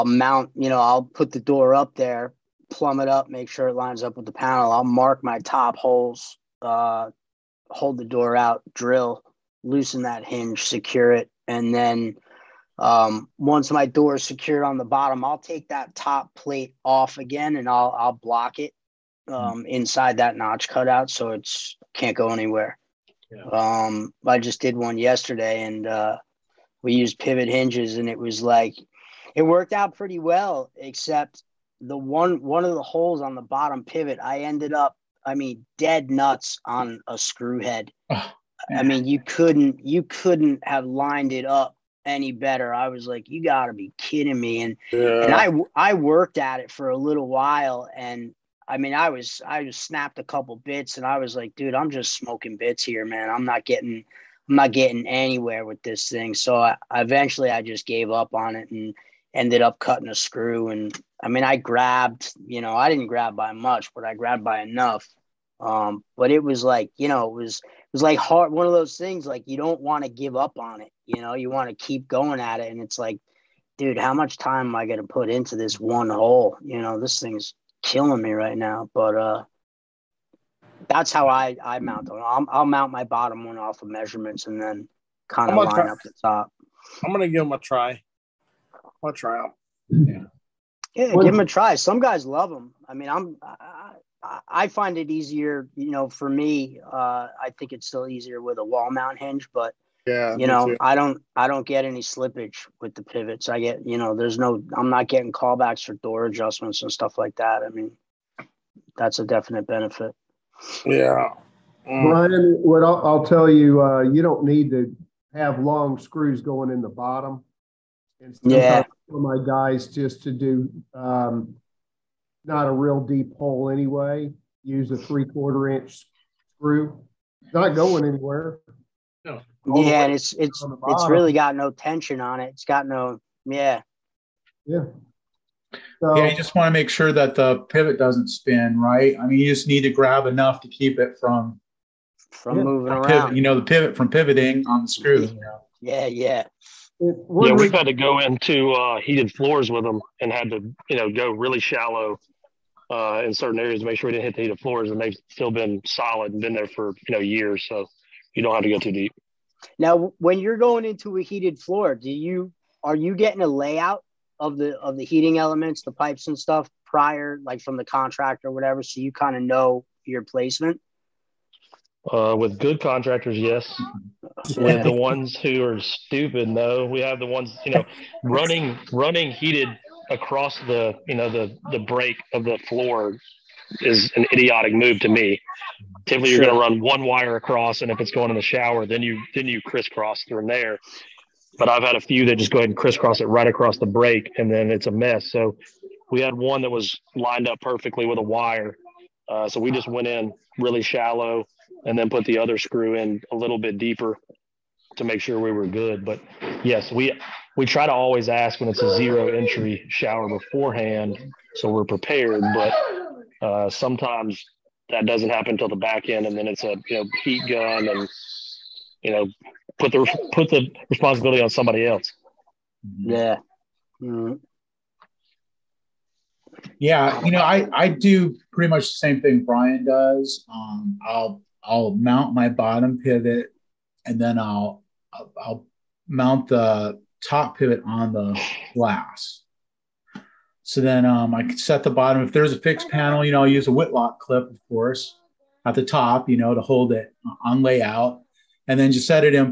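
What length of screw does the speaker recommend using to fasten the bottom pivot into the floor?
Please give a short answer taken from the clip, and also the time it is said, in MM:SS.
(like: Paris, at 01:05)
3/4 inch, at 02:04.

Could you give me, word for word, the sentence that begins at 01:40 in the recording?
I don't I don't get any slippage with the pivots.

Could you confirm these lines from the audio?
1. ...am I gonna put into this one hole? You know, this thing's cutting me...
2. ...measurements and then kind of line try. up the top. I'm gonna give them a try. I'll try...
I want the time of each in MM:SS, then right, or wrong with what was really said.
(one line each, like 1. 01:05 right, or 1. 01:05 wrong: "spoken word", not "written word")
1. 01:14 wrong: "killing", not "cutting"
2. 01:23 right.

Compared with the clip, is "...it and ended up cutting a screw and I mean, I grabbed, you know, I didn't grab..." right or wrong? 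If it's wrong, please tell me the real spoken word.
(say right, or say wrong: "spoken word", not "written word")
right.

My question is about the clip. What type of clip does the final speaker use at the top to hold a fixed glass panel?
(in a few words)
Whitlock clip.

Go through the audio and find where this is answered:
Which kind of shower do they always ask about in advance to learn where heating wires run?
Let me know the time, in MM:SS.
03:28.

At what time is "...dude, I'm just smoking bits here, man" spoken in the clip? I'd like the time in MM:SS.
00:51.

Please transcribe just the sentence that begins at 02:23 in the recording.
Pivot, you know, the pivot from pivoting on the screw.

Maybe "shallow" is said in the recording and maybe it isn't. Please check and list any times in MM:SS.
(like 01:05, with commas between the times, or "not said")
02:31, 03:20.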